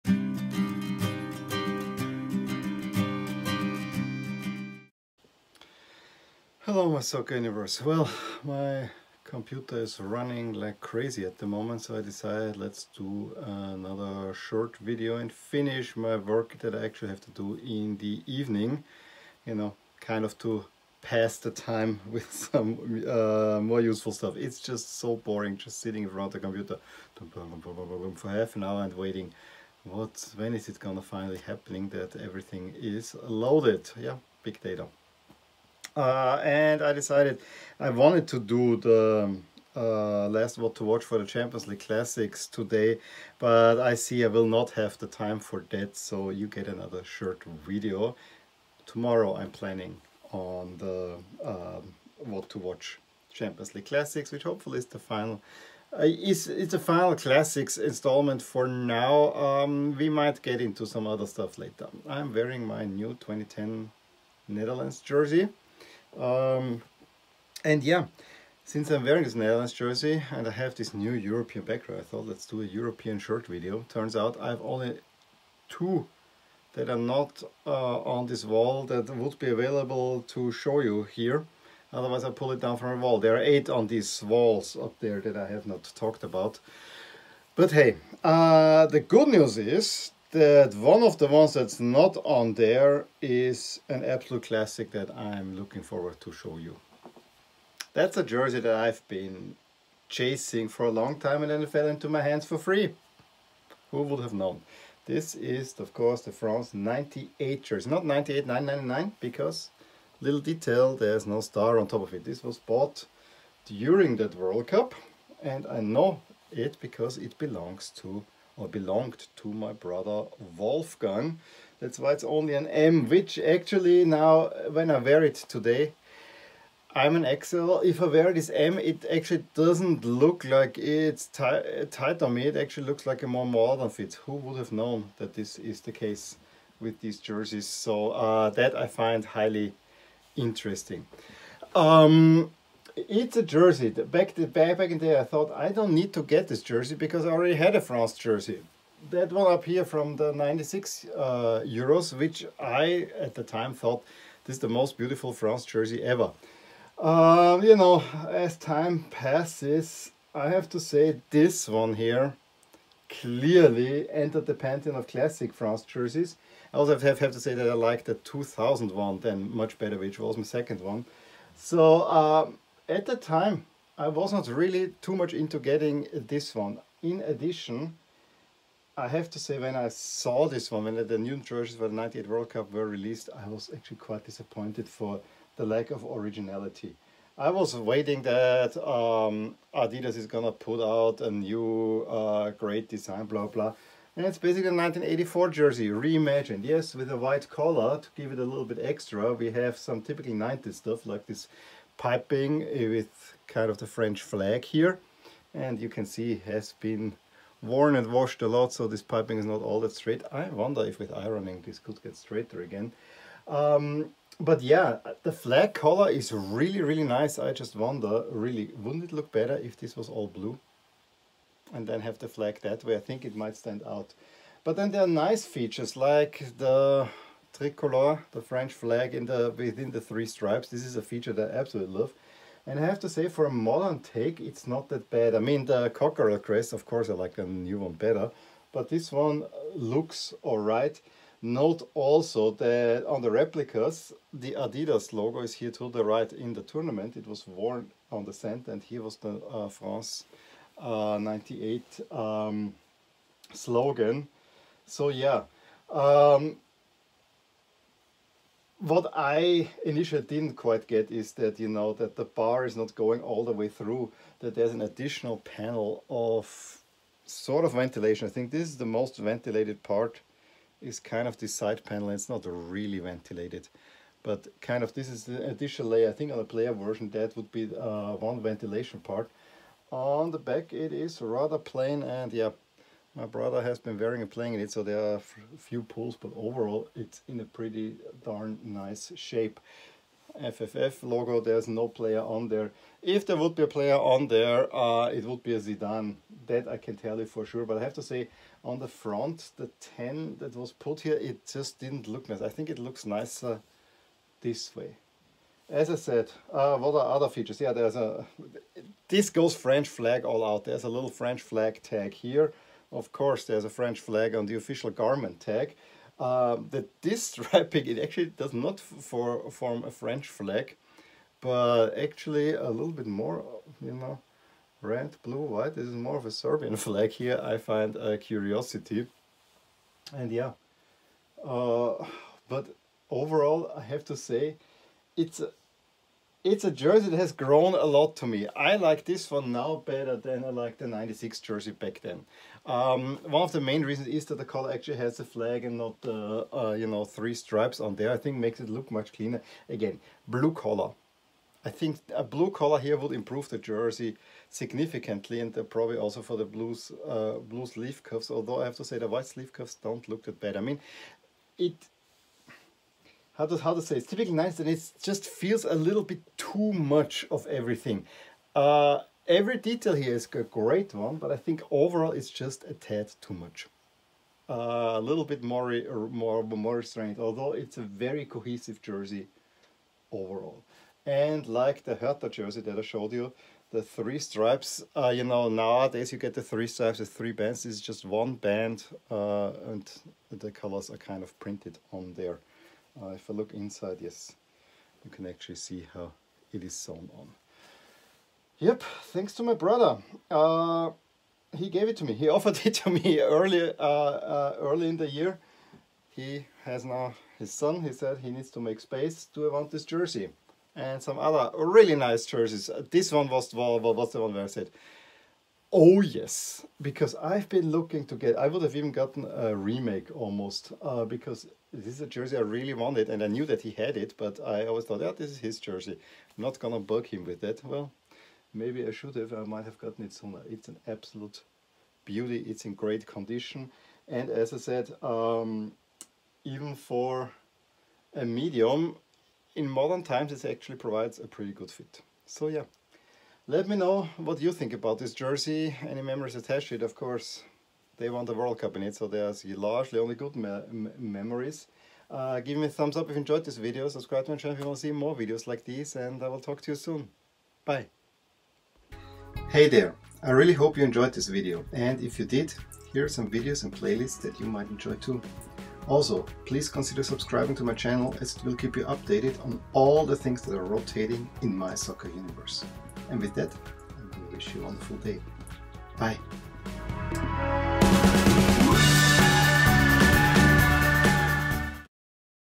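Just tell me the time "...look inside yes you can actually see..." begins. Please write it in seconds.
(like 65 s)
393 s.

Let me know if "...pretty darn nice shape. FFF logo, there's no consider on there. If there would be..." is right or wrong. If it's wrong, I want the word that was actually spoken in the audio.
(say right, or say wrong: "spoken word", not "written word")
wrong: "player", not "consider".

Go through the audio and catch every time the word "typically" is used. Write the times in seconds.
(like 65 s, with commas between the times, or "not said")
200 s, 364 s.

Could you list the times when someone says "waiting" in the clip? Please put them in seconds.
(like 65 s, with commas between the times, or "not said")
28 s, 187 s.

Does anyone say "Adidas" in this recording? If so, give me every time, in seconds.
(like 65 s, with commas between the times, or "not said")
189 s, 244 s.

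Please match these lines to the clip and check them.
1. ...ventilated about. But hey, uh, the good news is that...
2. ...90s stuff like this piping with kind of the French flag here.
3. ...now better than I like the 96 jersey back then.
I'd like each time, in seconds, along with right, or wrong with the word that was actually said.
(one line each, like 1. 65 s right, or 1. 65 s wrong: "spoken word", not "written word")
1. 85 s wrong: "talked", not "ventilated"
2. 200 s right
3. 339 s right.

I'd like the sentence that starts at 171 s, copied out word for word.
So um, at the time, I was not really too much into getting this one.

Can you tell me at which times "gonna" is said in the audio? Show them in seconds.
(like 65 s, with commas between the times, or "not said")
30 s, 190 s, 426 s.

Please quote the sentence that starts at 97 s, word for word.
That's a jersey that I've been chasing for a long time and then it fell into my hands for free.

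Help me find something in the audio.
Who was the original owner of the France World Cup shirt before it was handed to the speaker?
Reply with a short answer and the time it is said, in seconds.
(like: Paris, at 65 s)
Wolfgang, at 119 s.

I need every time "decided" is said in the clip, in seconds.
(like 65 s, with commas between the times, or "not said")
12 s, 36 s.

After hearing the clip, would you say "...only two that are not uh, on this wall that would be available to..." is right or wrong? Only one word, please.
right.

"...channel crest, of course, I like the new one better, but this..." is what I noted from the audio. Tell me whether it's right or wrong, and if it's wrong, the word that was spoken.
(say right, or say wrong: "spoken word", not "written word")
wrong: "cockerel", not "channel".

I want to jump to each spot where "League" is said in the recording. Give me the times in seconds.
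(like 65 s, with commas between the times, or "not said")
41 s, 53 s.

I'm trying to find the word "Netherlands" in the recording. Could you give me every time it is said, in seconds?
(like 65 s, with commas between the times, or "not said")
64 s, 69 s.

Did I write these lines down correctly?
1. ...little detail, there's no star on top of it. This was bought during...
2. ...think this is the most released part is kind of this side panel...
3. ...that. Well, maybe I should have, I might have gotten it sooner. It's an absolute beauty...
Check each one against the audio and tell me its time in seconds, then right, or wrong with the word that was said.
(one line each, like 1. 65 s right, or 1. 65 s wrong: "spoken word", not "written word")
1. 110 s right
2. 268 s wrong: "ventilated", not "released"
3. 427 s right.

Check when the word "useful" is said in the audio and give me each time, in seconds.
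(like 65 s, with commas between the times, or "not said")
23 s.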